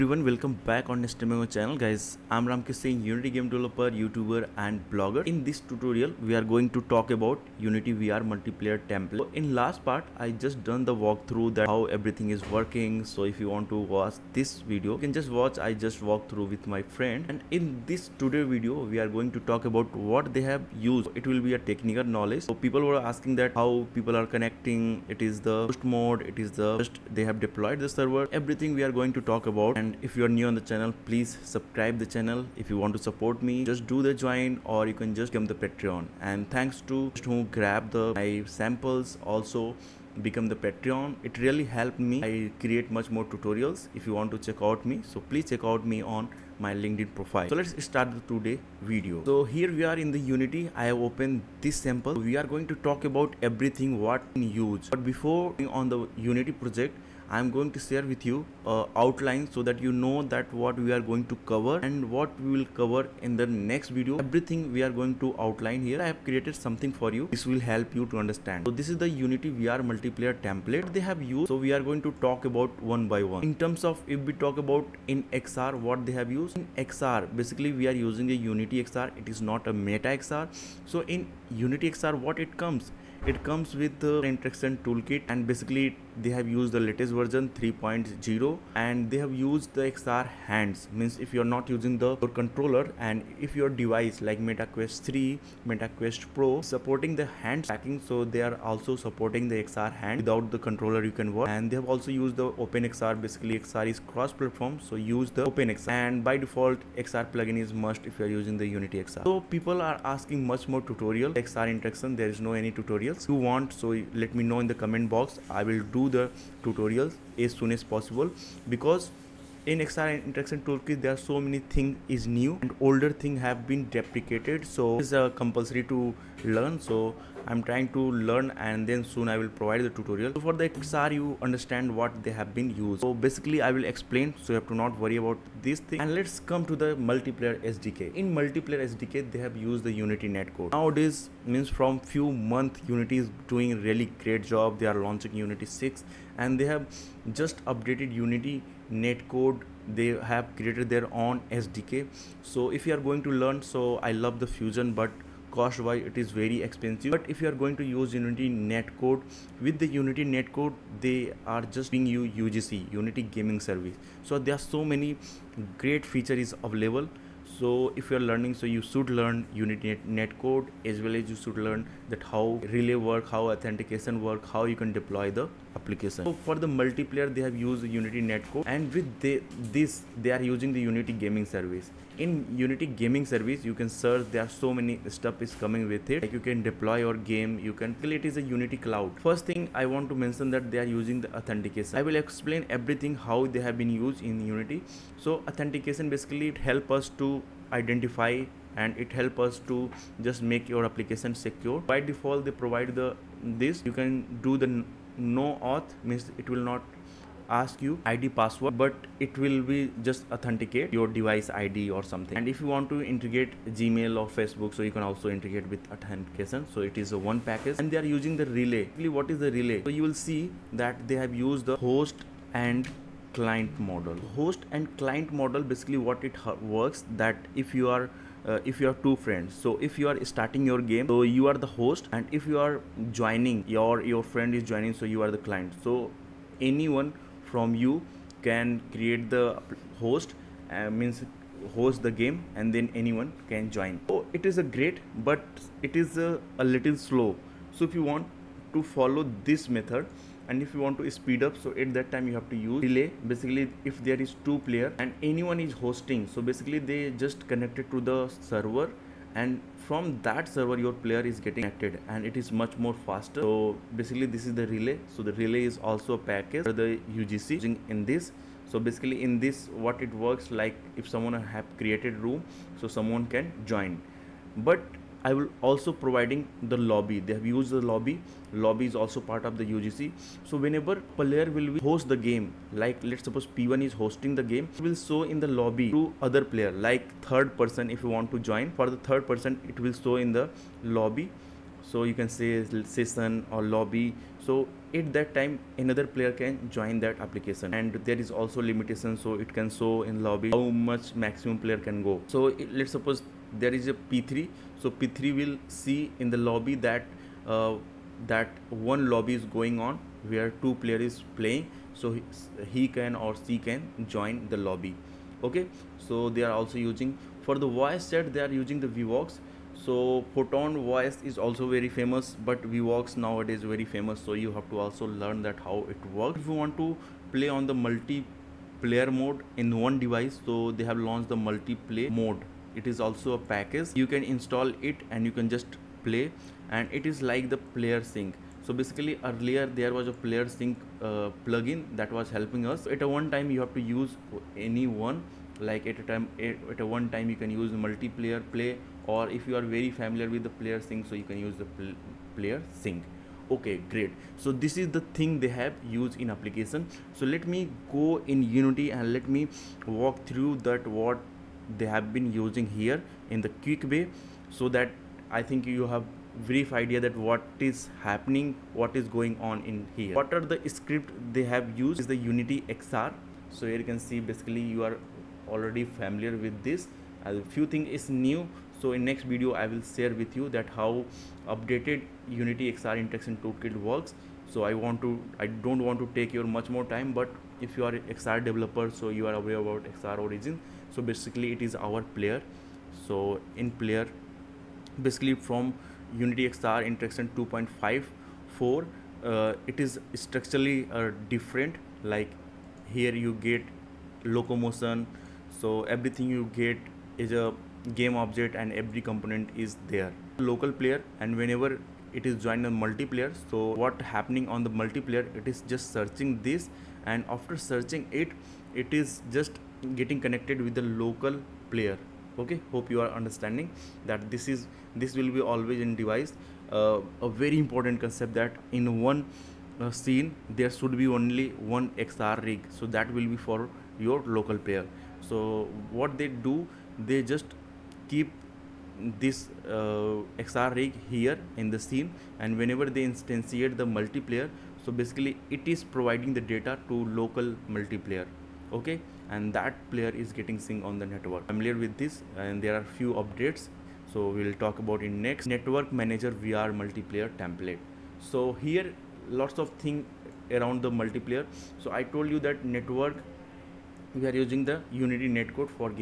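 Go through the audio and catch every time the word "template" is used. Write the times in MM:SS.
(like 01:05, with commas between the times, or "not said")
00:08, 01:10, 07:37.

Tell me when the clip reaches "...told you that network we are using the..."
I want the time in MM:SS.
07:42.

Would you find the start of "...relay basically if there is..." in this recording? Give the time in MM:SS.
04:12.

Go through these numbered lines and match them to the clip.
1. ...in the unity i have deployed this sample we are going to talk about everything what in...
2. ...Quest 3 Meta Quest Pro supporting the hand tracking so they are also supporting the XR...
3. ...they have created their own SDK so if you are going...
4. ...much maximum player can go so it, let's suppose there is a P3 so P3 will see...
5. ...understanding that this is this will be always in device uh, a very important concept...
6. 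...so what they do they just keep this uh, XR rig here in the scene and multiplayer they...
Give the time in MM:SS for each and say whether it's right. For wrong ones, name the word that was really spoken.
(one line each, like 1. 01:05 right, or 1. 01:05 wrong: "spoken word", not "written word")
1. 00:50 wrong: "opened", not "deployed"
2. 01:34 right
3. 02:29 right
4. 05:00 right
5. 07:03 right
6. 07:15 wrong: "whenever", not "multiplayer".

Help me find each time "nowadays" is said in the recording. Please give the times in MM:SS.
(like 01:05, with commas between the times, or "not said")
02:20, 05:23.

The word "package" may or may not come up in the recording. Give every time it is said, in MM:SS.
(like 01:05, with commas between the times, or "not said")
03:37, 04:26, 05:33.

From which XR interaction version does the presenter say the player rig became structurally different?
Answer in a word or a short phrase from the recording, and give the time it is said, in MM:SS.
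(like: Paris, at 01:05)
2.54, at 06:37.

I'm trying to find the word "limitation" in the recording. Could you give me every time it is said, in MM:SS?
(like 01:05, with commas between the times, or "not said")
04:58.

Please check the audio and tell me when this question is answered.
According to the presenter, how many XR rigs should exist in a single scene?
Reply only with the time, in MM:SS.
07:11.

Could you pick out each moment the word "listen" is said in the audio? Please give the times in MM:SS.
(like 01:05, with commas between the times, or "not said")
not said.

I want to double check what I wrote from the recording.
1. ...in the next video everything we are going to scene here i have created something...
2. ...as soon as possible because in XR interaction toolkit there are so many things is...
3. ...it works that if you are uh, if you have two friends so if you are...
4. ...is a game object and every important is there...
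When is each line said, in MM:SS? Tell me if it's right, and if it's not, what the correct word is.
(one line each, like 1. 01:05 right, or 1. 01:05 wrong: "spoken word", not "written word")
1. 01:03 wrong: "outline", not "scene"
2. 01:57 right
3. 03:46 right
4. 06:47 wrong: "component", not "important".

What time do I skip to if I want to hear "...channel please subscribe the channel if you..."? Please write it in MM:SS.
00:30.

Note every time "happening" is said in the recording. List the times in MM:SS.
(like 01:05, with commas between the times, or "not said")
06:08, 06:54.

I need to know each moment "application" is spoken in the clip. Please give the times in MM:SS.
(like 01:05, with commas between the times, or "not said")
02:55, 03:20, 04:57, 05:56.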